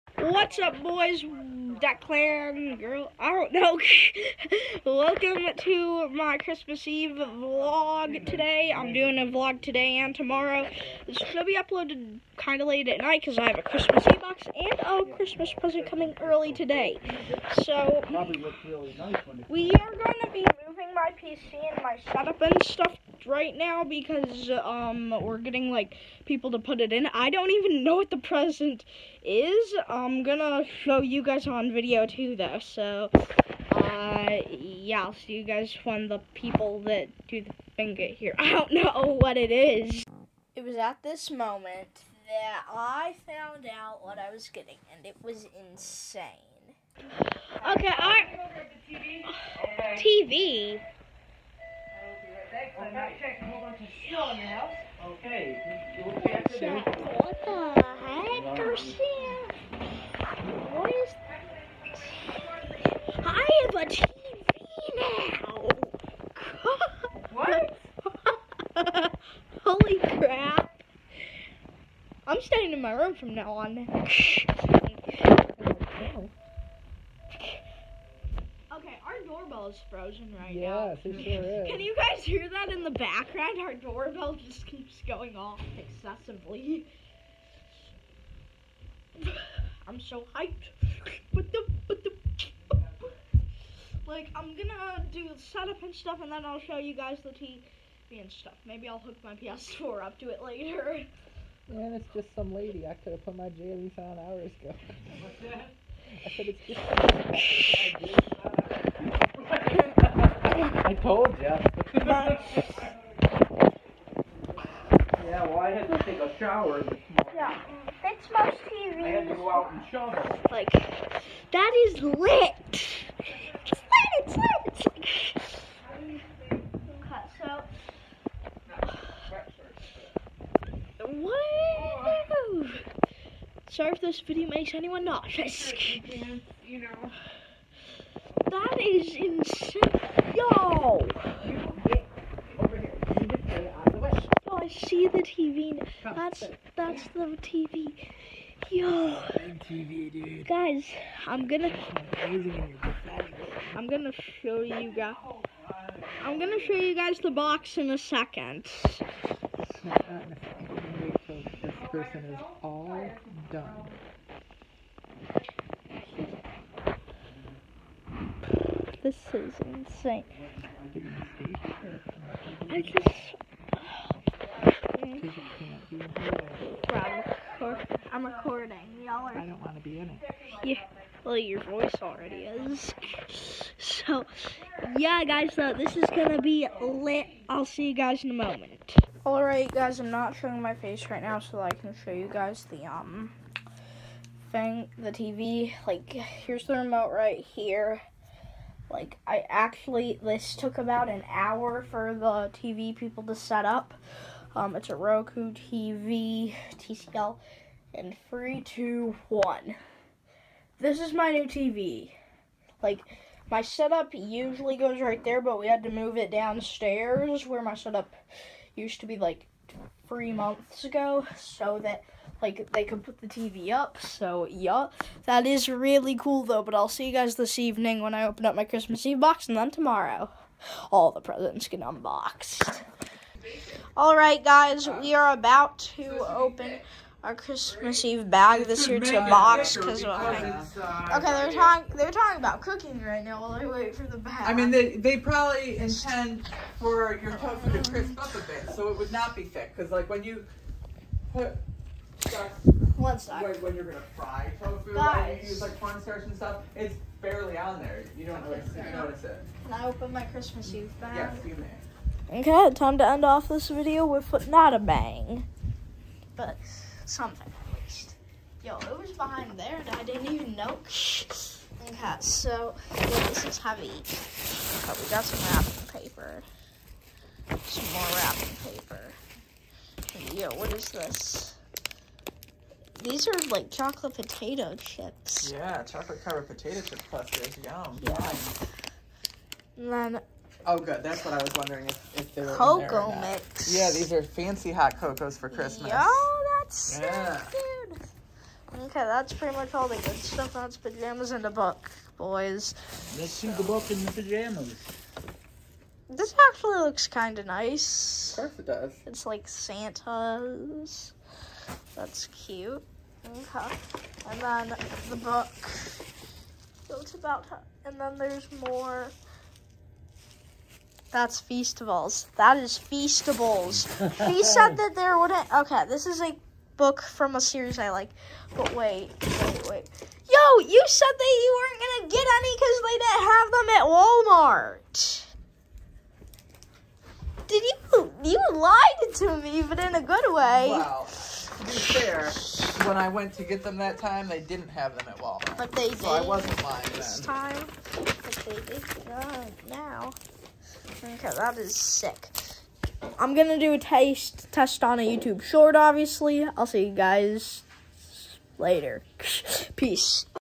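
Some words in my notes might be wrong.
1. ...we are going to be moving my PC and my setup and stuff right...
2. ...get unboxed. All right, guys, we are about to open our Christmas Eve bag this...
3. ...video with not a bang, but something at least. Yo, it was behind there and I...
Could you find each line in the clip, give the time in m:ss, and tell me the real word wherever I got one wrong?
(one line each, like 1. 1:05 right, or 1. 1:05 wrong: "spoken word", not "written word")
1. 0:19 right
2. 3:51 right
3. 4:23 right.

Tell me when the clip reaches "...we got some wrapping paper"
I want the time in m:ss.
4:35.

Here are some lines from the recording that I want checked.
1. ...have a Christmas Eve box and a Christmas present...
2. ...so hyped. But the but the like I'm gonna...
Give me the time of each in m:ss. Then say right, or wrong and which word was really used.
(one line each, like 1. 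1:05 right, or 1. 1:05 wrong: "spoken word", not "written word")
1. 0:13 right
2. 1:29 right.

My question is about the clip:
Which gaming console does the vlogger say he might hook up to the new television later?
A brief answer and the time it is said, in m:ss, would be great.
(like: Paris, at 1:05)
PS4, at 1:39.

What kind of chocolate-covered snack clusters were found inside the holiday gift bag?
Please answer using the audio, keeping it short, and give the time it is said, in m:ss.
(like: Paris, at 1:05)
potato chip clusters, at 4:46.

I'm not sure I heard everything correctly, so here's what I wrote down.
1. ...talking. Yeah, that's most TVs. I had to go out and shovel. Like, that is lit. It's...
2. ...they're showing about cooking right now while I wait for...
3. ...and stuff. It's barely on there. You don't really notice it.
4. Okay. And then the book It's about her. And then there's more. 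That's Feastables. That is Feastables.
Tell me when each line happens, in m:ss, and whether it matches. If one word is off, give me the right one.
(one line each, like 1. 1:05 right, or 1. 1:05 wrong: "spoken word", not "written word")
1. 1:56 wrong: "morning", not "talking"
2. 4:01 wrong: "talking", not "showing"
3. 4:16 right
4. 5:13 right.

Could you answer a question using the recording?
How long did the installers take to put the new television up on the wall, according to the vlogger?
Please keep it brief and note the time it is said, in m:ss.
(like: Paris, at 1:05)
about an hour, at 3:20.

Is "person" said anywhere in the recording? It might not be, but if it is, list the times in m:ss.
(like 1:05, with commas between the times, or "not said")
2:41.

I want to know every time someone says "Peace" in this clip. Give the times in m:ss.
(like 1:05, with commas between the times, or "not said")
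5:59.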